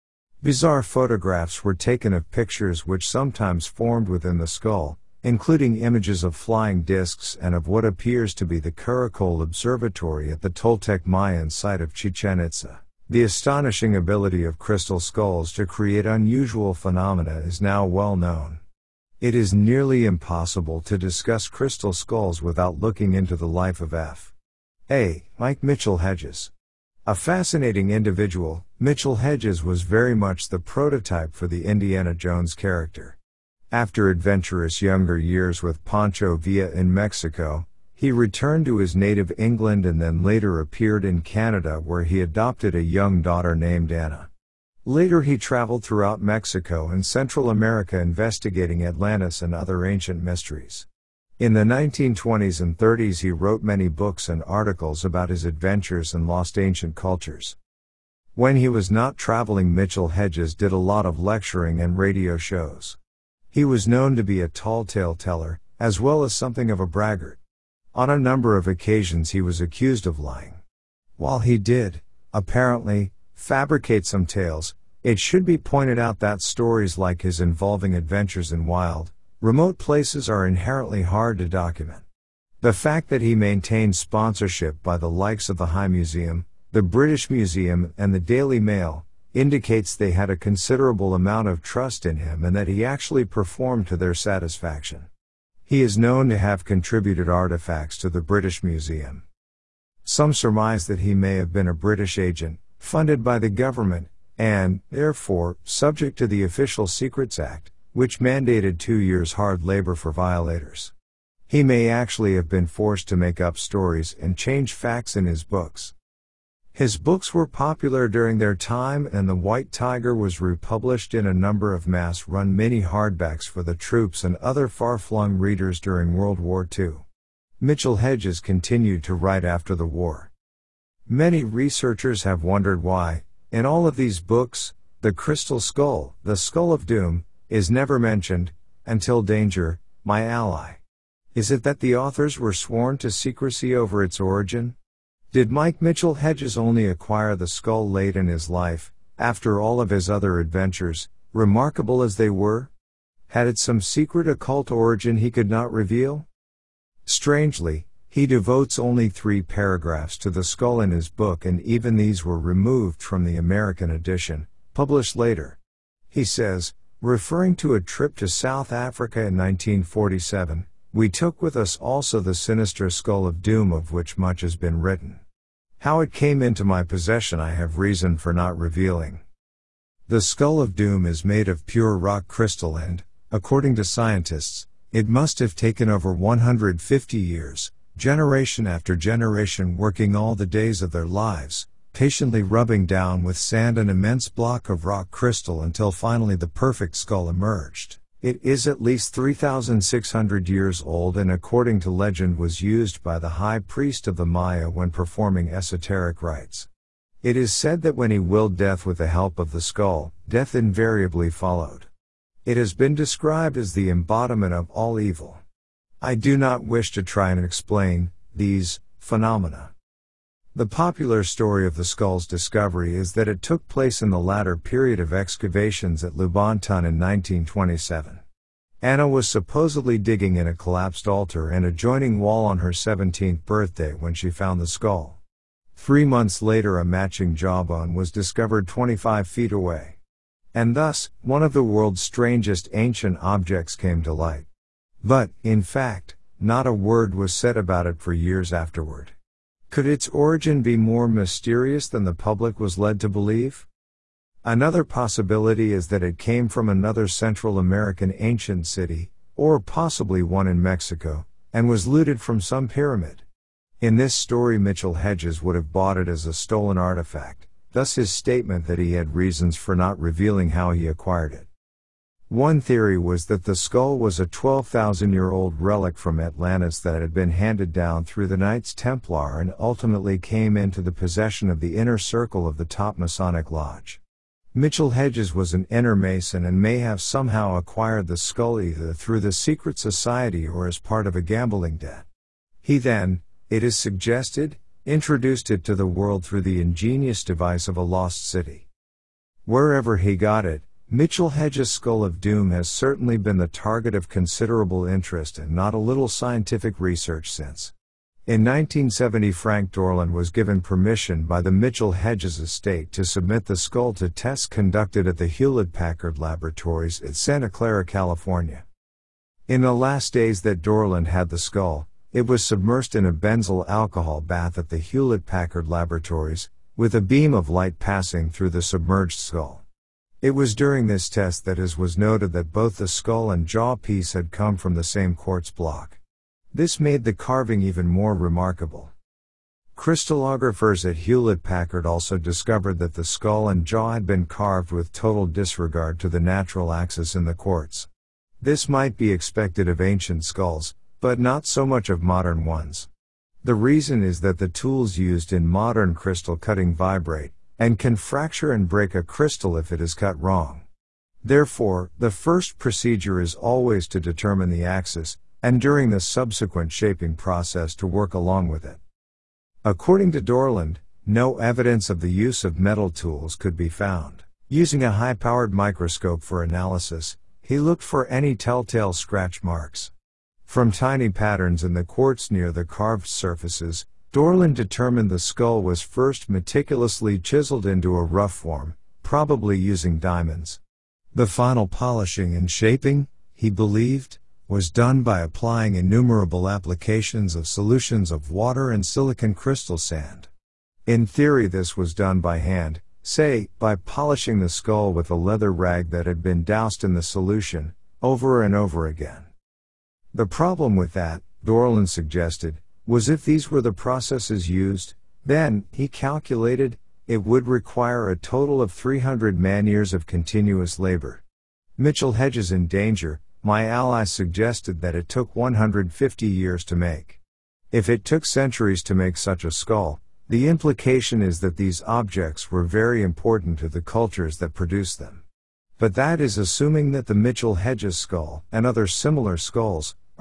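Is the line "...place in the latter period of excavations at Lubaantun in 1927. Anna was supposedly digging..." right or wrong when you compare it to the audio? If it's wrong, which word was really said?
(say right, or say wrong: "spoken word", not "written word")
right.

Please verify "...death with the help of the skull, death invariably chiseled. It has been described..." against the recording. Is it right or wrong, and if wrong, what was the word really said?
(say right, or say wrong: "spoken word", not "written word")
wrong: "followed", not "chiseled".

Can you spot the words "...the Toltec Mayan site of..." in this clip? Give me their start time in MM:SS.
00:10.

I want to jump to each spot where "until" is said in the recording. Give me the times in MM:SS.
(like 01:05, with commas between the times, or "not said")
02:18, 03:15.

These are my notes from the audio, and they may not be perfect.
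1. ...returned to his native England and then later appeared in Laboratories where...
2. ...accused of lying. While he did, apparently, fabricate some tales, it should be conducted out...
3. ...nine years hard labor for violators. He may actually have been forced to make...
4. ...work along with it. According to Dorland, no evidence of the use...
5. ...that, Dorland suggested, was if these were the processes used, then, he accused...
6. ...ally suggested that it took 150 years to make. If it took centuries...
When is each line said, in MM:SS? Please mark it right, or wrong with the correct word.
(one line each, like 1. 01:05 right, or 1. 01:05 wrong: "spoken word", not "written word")
1. 00:38 wrong: "Canada", not "Laboratories"
2. 01:09 wrong: "pointed", not "conducted"
3. 01:48 wrong: "two", not "nine"
4. 06:07 right
5. 06:50 wrong: "calculated", not "accused"
6. 07:03 right.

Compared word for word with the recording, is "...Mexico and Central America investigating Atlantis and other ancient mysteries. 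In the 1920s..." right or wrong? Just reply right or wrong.
right.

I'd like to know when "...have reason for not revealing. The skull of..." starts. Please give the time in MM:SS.
02:57.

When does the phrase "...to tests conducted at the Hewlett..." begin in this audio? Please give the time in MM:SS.
05:13.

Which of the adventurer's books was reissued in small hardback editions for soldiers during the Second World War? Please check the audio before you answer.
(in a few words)
The White Tiger.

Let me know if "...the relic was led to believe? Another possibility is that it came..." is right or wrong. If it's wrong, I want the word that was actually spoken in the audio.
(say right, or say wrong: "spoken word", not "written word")
wrong: "public", not "relic".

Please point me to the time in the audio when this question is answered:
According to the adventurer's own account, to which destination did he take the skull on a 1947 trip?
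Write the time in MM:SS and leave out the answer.
02:48.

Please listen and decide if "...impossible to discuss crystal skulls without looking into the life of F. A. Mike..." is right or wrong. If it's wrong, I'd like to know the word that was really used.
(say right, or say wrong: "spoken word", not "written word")
right.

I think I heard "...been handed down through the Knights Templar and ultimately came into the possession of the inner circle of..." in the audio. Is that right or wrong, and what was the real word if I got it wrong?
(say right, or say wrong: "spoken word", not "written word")
right.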